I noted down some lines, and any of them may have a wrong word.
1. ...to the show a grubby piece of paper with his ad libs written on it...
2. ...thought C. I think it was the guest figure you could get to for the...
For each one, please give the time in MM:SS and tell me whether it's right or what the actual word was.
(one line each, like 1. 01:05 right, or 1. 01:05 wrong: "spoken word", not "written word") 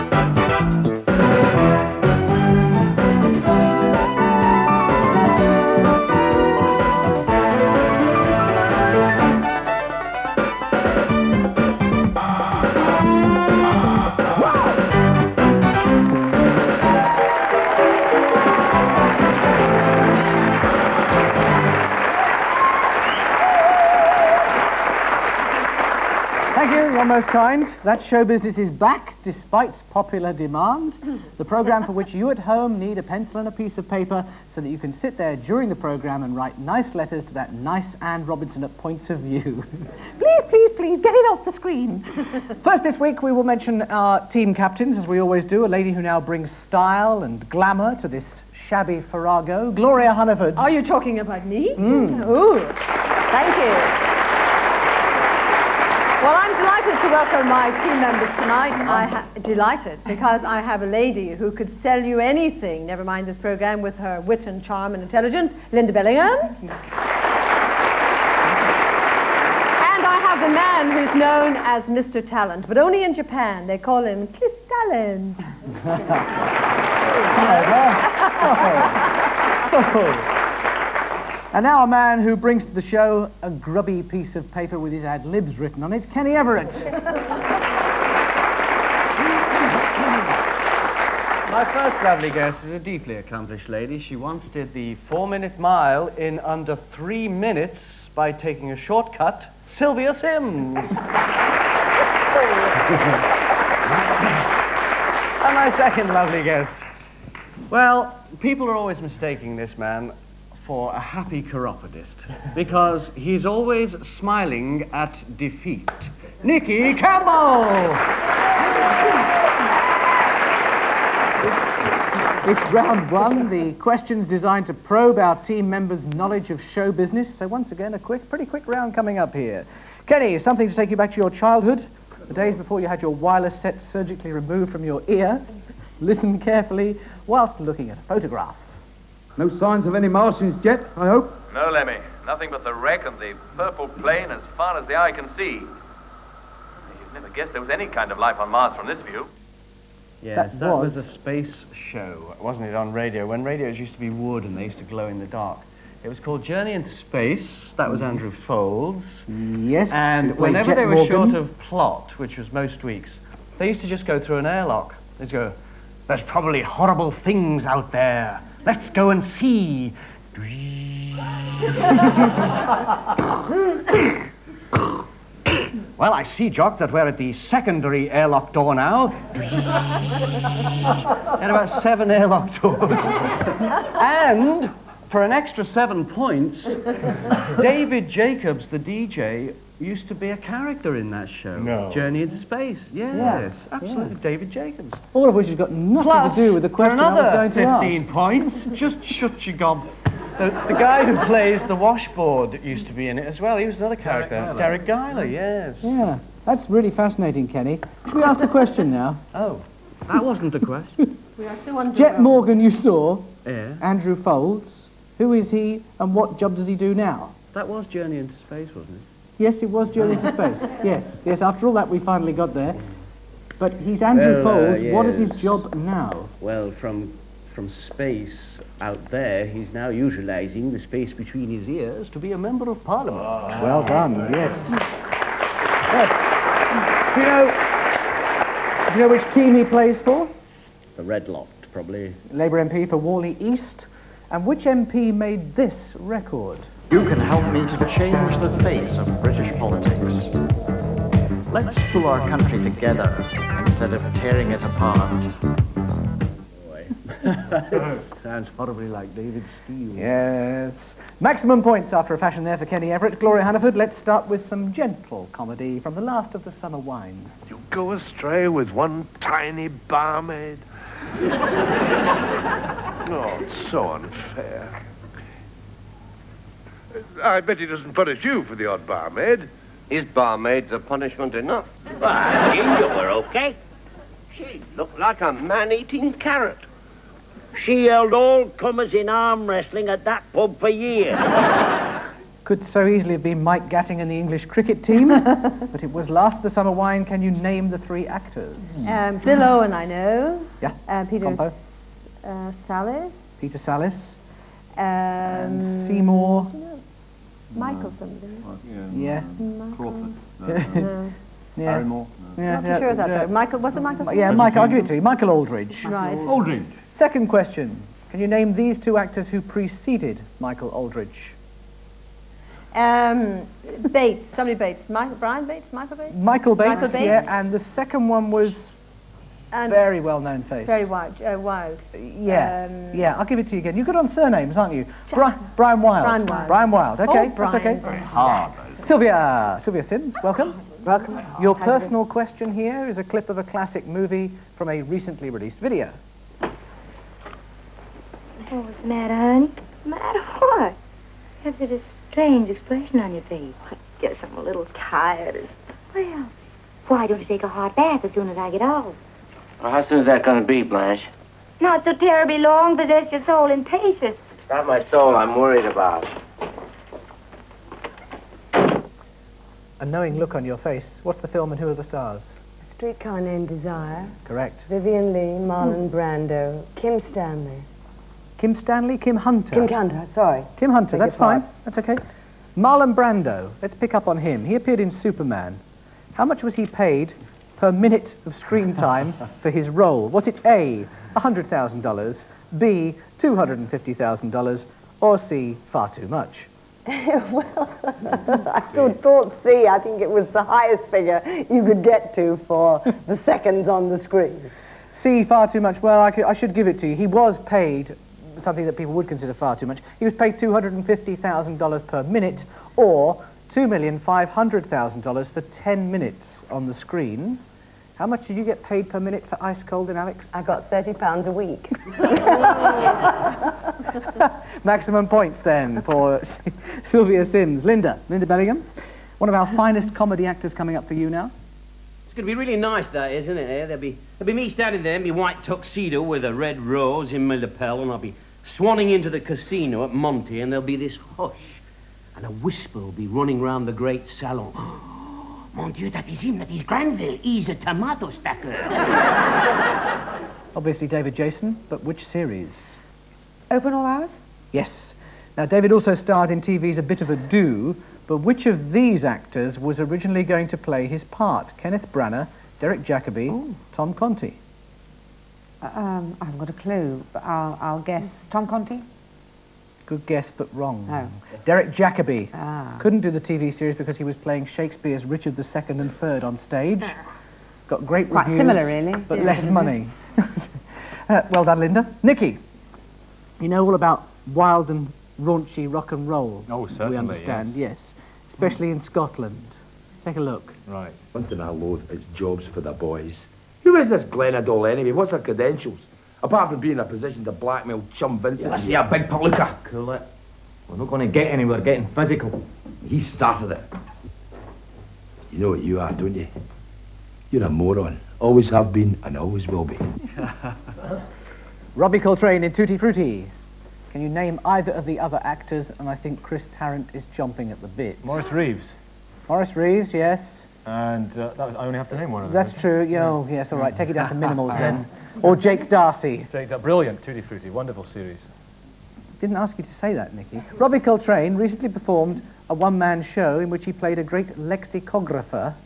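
1. 01:22 right
2. 06:38 wrong: "highest", not "guest".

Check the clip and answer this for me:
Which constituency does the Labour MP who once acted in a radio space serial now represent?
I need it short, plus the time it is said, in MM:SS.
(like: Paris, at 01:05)
Warley East, at 04:02.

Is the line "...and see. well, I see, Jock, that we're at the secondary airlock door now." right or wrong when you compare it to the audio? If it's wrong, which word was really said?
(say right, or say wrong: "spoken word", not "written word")
right.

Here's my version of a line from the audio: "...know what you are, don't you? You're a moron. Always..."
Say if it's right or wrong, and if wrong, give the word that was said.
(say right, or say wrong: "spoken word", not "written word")
right.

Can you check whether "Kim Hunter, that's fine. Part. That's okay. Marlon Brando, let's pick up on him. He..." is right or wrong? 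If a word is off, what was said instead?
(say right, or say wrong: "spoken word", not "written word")
right.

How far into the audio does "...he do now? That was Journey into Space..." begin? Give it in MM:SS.
03:36.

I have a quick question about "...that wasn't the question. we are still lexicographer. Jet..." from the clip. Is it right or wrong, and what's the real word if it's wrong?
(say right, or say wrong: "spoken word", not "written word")
wrong: "under", not "lexicographer".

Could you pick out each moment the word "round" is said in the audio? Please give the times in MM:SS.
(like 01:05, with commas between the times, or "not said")
02:02, 02:08, 07:23.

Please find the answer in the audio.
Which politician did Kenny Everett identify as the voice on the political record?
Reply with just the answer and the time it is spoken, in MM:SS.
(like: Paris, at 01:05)
David Steel, at 04:18.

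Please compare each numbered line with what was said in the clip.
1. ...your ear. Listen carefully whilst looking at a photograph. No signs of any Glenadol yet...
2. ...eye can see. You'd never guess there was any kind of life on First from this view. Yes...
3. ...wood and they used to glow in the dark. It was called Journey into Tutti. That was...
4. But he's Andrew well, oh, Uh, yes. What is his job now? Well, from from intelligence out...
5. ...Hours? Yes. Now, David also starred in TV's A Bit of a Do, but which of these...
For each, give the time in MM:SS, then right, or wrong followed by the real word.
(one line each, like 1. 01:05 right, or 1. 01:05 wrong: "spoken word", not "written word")
1. 02:14 wrong: "Martians", not "Glenadol"
2. 02:24 wrong: "Mars", not "First"
3. 02:34 wrong: "Space", not "Tutti"
4. 03:43 wrong: "space", not "intelligence"
5. 07:33 right.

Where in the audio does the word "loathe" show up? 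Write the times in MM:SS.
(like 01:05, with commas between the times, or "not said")
08:11.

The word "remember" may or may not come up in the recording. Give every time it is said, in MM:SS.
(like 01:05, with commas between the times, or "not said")
not said.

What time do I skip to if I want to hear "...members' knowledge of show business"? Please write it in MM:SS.
02:05.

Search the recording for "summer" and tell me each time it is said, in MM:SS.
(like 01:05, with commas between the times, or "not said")
04:26, 04:56.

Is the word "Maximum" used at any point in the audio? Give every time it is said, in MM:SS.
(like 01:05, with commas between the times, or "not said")
04:21, 07:04.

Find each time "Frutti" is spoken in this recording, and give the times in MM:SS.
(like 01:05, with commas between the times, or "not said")
08:32, 08:47.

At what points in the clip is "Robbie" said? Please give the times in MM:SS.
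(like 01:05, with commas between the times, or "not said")
08:31, 08:50.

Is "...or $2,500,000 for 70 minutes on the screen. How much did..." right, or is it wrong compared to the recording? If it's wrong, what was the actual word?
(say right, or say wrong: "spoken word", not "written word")
wrong: "10", not "70".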